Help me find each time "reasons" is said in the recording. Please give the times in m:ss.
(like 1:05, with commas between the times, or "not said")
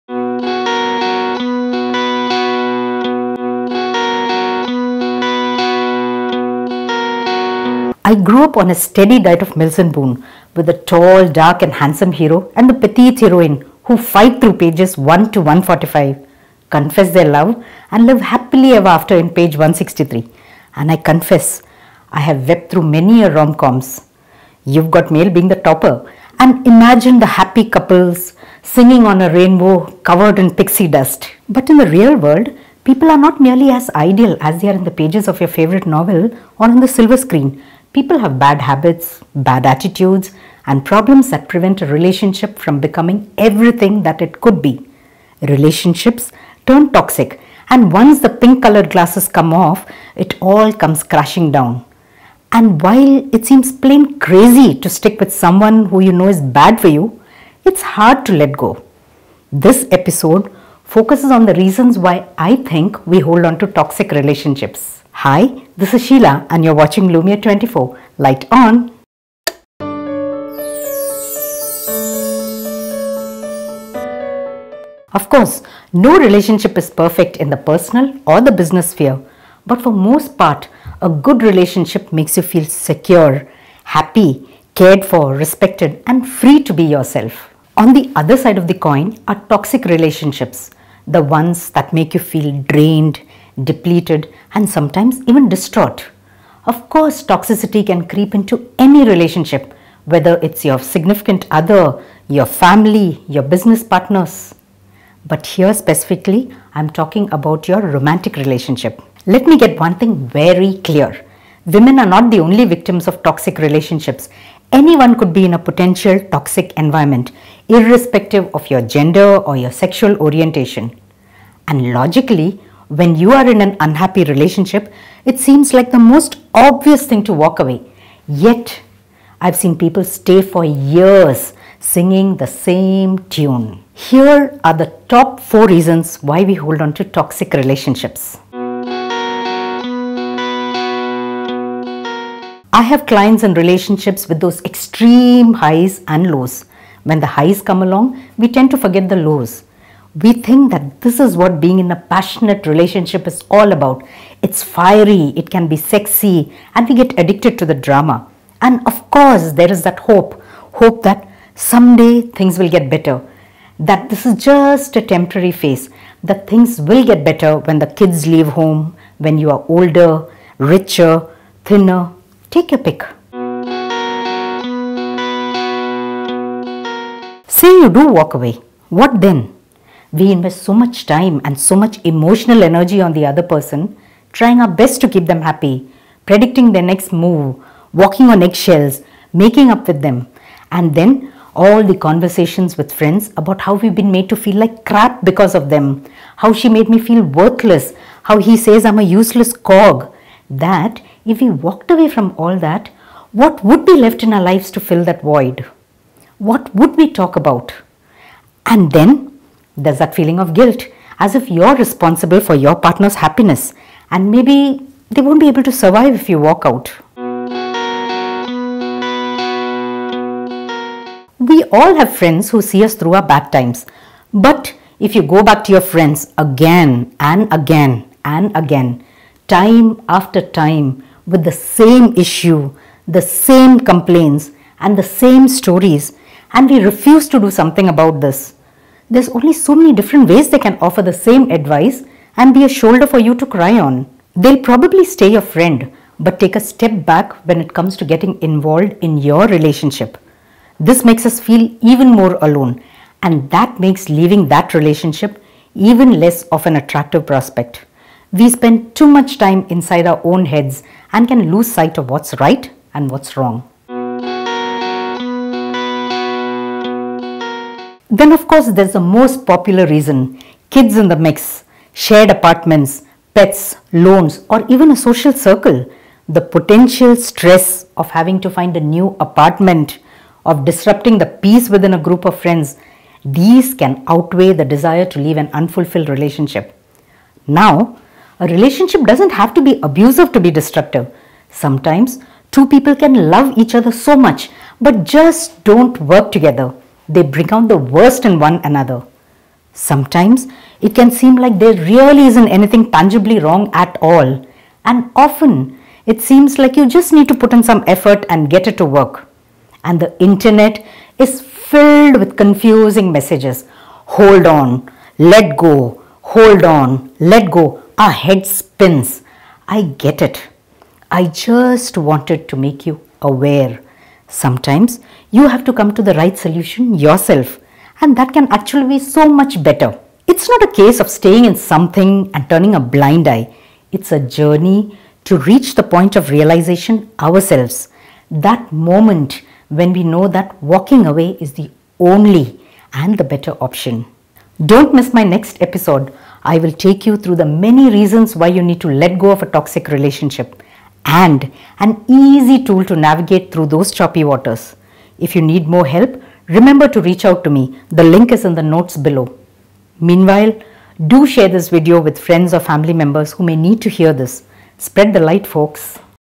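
1:01, 2:15, 4:29, 5:47.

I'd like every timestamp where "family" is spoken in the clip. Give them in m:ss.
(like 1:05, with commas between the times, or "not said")
1:42, 6:02.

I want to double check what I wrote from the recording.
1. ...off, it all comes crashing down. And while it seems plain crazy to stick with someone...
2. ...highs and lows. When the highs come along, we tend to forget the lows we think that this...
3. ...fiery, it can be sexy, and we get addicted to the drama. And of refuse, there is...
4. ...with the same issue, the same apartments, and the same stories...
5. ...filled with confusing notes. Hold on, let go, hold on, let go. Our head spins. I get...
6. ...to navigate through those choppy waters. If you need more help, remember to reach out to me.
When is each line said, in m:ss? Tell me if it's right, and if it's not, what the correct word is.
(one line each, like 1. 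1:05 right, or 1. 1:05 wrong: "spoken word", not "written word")
1. 0:49 right
2. 2:25 right
3. 2:34 wrong: "course", not "refuse"
4. 3:51 wrong: "complaints", not "apartments"
5. 5:11 wrong: "messages", not "notes"
6. 5:52 right.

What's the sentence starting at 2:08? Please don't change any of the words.
Yet, I've seen people stay for years singing the same tune.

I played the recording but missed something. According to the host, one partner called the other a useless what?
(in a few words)
cog.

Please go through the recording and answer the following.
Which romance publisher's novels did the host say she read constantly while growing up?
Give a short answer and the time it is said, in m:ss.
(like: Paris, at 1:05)
Mills and Boon, at 0:09.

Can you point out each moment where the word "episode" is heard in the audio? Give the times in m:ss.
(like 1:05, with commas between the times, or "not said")
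0:59, 5:45.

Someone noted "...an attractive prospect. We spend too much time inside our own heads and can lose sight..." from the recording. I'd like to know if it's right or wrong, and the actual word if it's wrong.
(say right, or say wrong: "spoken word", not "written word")
right.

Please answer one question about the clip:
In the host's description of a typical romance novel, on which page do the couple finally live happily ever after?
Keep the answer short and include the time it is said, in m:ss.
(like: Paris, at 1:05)
163, at 0:19.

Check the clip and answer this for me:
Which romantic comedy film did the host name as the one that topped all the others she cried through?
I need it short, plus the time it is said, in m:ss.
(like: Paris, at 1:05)
You've Got Mail, at 0:24.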